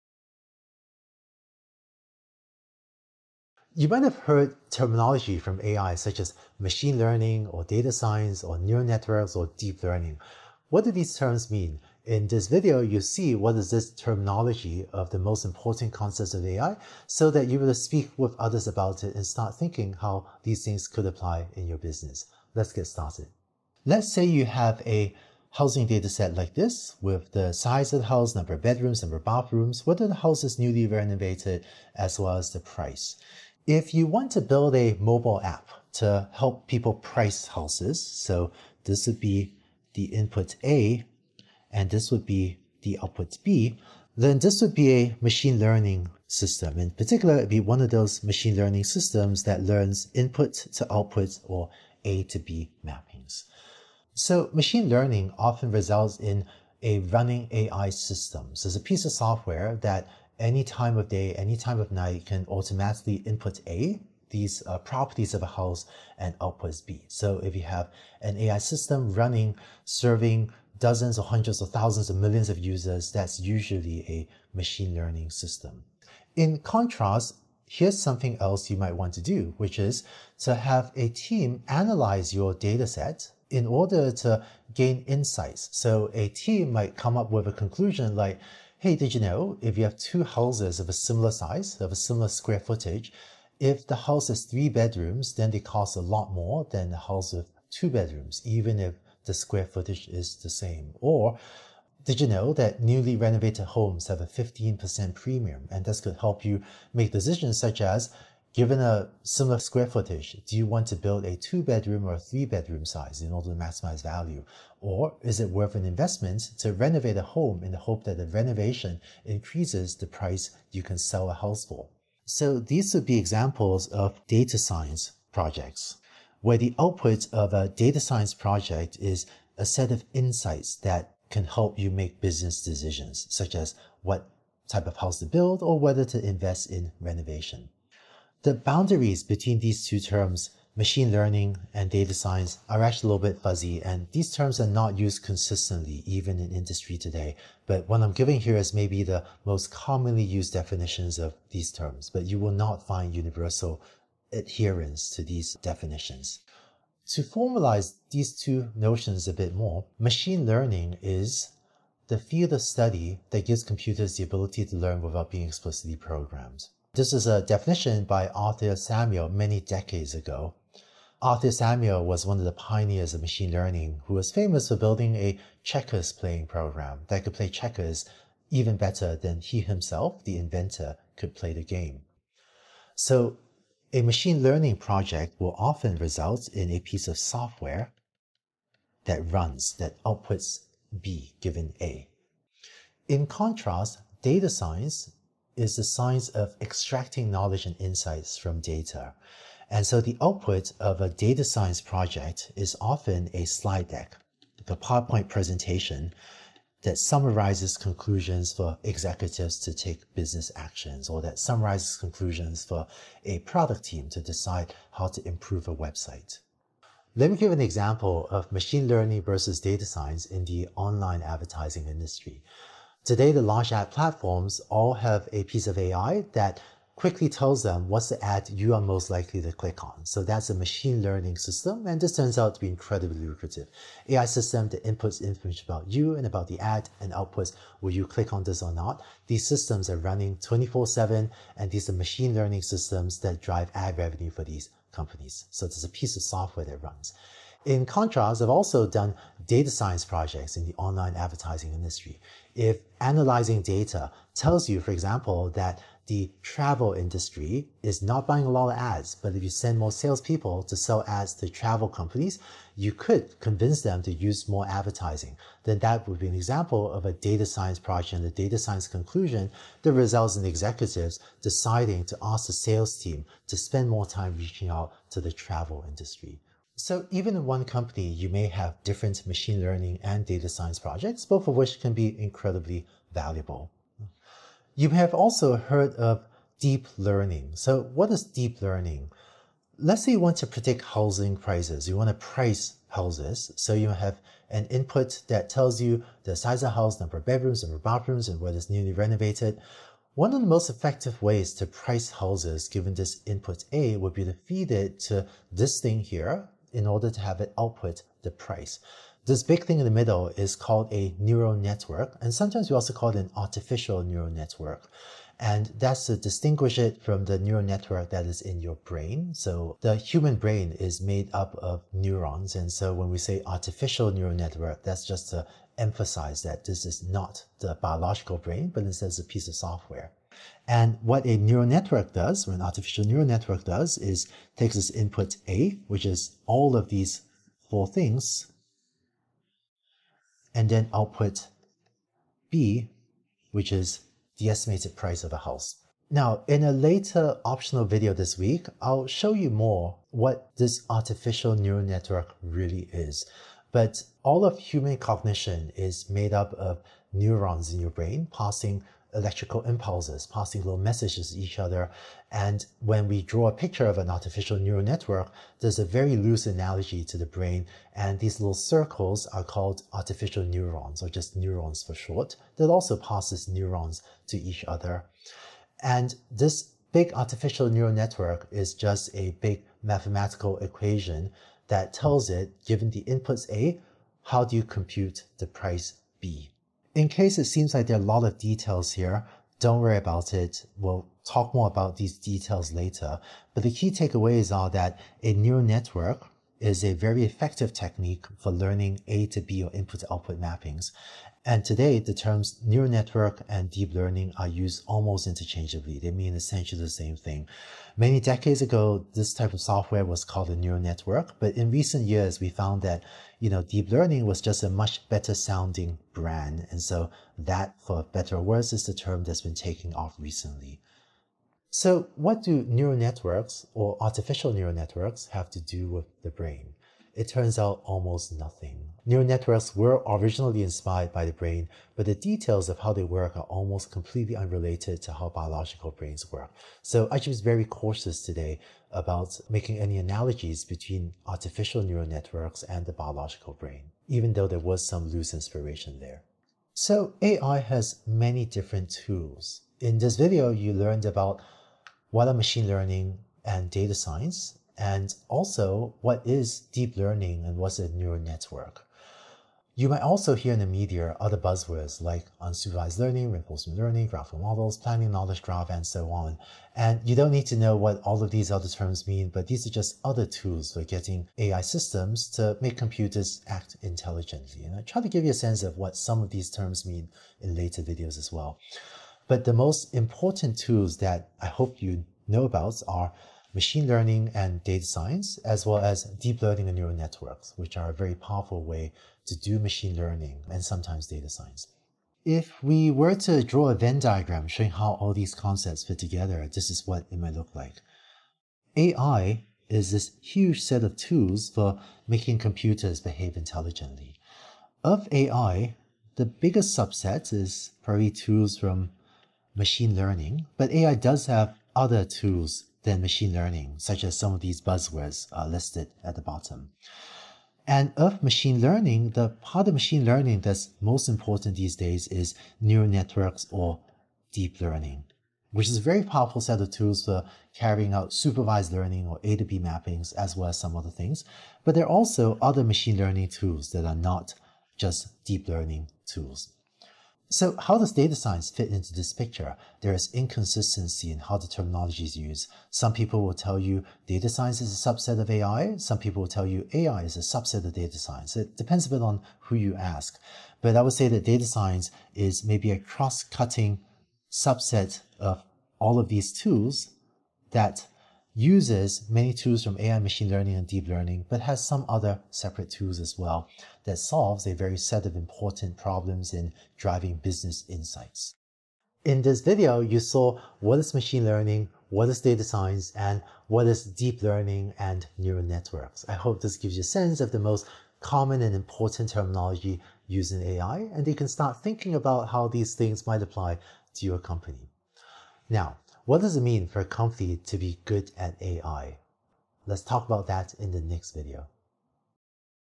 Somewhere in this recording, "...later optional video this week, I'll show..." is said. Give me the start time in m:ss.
5:46.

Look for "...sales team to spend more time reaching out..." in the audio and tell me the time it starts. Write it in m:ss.
4:32.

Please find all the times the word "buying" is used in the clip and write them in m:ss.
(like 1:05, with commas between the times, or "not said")
4:18.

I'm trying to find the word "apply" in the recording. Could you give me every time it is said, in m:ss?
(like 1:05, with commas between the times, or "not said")
0:21, 9:43.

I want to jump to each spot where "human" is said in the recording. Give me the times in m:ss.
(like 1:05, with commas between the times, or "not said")
5:19, 5:54.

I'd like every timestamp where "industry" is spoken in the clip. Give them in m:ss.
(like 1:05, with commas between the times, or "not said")
2:26, 3:41, 4:11, 4:16, 4:35.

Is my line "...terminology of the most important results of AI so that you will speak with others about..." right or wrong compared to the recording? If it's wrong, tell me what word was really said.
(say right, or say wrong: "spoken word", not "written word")
wrong: "concepts", not "results".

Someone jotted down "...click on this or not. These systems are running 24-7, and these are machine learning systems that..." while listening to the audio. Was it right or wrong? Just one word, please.
right.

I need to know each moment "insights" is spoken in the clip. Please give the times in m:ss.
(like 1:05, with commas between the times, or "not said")
1:25, 2:10, 3:17, 9:27.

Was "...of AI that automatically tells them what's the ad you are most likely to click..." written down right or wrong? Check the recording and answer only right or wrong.
wrong.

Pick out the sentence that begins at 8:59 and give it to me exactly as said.
There is inconsistency in how the terminology is used.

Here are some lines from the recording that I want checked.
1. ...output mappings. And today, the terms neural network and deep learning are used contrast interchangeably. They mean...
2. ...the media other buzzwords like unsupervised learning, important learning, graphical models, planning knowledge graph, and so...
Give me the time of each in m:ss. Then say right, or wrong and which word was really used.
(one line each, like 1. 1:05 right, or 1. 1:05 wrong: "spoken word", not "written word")
1. 6:40 wrong: "almost", not "contrast"
2. 7:40 wrong: "reinforcement", not "important".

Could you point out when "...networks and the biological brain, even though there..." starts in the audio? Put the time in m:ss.
7:22.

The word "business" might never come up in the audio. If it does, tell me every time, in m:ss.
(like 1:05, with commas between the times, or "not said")
0:21, 2:12, 3:30, 9:27.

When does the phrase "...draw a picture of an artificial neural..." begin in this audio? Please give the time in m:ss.
6:03.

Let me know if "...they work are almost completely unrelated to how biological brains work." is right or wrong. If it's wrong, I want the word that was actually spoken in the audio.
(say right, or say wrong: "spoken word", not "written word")
right.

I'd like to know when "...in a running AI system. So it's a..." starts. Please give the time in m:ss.
0:56.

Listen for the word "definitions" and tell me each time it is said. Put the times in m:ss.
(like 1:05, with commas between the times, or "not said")
2:30, 2:35, 2:47.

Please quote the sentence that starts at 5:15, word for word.
And that's to distinguish it from the neural network that is in your brain.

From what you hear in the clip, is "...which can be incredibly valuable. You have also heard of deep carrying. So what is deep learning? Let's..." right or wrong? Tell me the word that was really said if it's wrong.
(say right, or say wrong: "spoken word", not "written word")
wrong: "learning", not "carrying".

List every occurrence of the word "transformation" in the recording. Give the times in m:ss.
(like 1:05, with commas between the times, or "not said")
not said.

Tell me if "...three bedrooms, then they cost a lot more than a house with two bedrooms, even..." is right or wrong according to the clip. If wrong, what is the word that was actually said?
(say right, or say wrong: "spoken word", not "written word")
right.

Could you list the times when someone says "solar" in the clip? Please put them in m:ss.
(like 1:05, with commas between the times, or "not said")
not said.